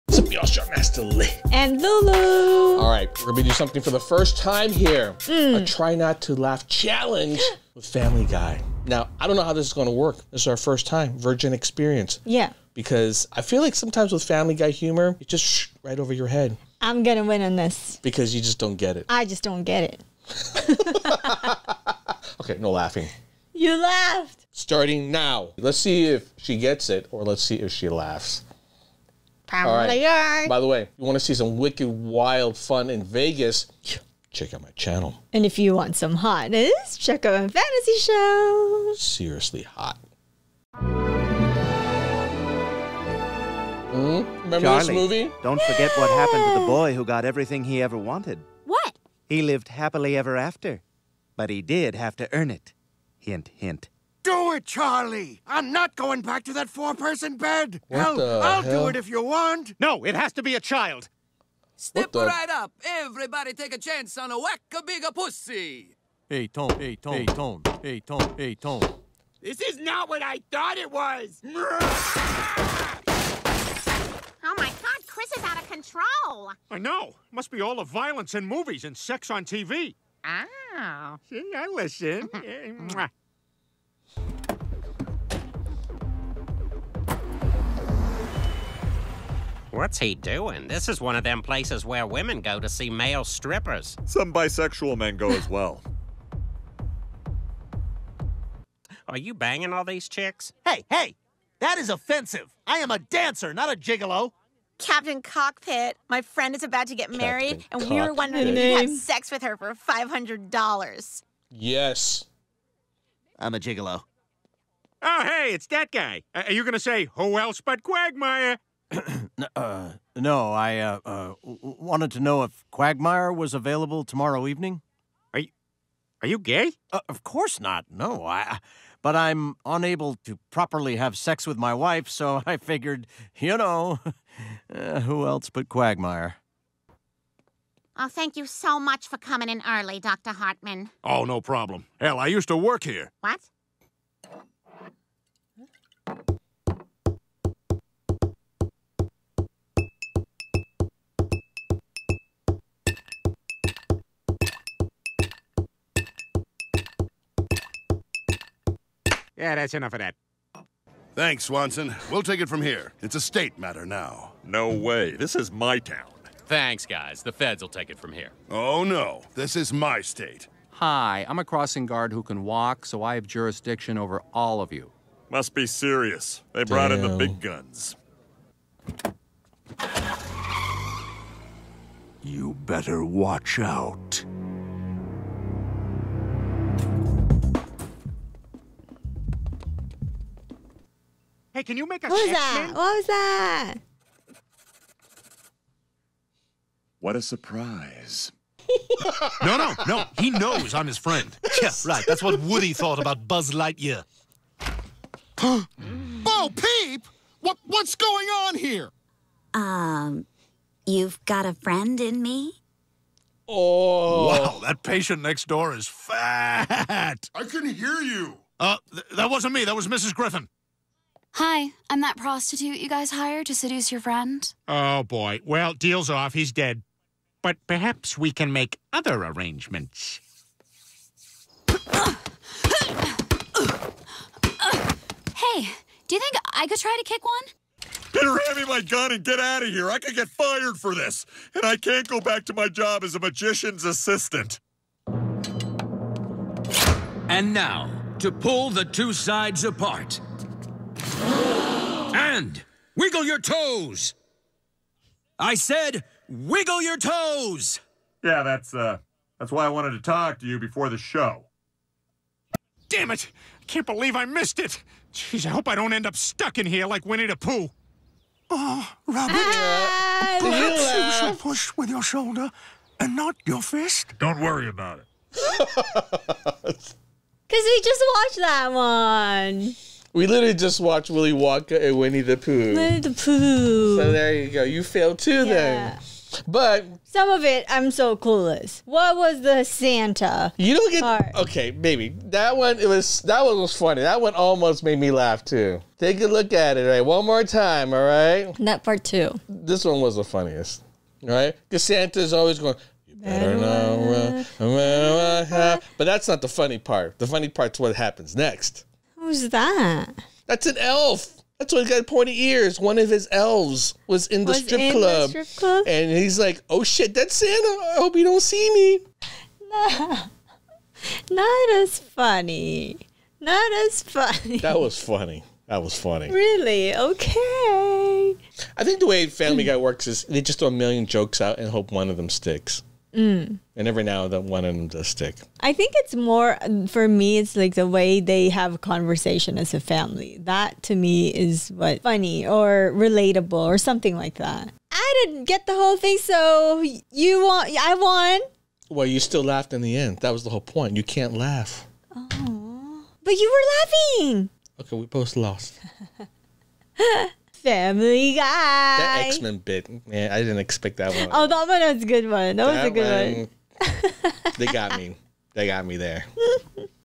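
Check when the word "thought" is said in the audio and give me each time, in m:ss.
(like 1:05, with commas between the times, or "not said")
1:10, 3:22.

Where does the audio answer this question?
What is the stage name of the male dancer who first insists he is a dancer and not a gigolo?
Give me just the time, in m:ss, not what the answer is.
1:44.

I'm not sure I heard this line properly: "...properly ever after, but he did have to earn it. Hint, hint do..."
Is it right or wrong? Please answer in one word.
wrong.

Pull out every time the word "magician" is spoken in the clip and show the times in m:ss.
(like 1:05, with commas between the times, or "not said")
4:03.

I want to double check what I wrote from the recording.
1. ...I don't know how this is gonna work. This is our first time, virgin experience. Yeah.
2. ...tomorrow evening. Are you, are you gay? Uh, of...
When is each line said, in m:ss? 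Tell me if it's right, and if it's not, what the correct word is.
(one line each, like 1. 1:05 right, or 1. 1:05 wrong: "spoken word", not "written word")
1. 0:09 right
2. 2:04 right.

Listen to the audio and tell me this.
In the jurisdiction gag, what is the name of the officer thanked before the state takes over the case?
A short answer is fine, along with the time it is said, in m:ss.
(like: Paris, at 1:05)
Swanson, at 2:41.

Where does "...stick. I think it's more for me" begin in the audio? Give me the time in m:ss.
5:35.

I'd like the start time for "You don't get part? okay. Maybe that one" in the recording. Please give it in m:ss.
4:50.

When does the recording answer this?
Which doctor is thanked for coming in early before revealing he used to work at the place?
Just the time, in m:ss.
2:19.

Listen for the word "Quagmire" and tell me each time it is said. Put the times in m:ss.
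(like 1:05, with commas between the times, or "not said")
1:57, 2:02, 2:15.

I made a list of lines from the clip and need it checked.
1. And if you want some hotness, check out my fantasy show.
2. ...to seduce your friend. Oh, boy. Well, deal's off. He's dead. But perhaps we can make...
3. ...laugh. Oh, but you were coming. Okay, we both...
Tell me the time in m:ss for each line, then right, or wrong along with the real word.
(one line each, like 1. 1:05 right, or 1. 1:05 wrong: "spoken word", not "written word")
1. 0:35 right
2. 3:43 right
3. 5:51 wrong: "laughing", not "coming".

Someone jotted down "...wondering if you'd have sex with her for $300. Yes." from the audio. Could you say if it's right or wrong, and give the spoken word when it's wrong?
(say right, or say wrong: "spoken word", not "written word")
wrong: "500", not "300".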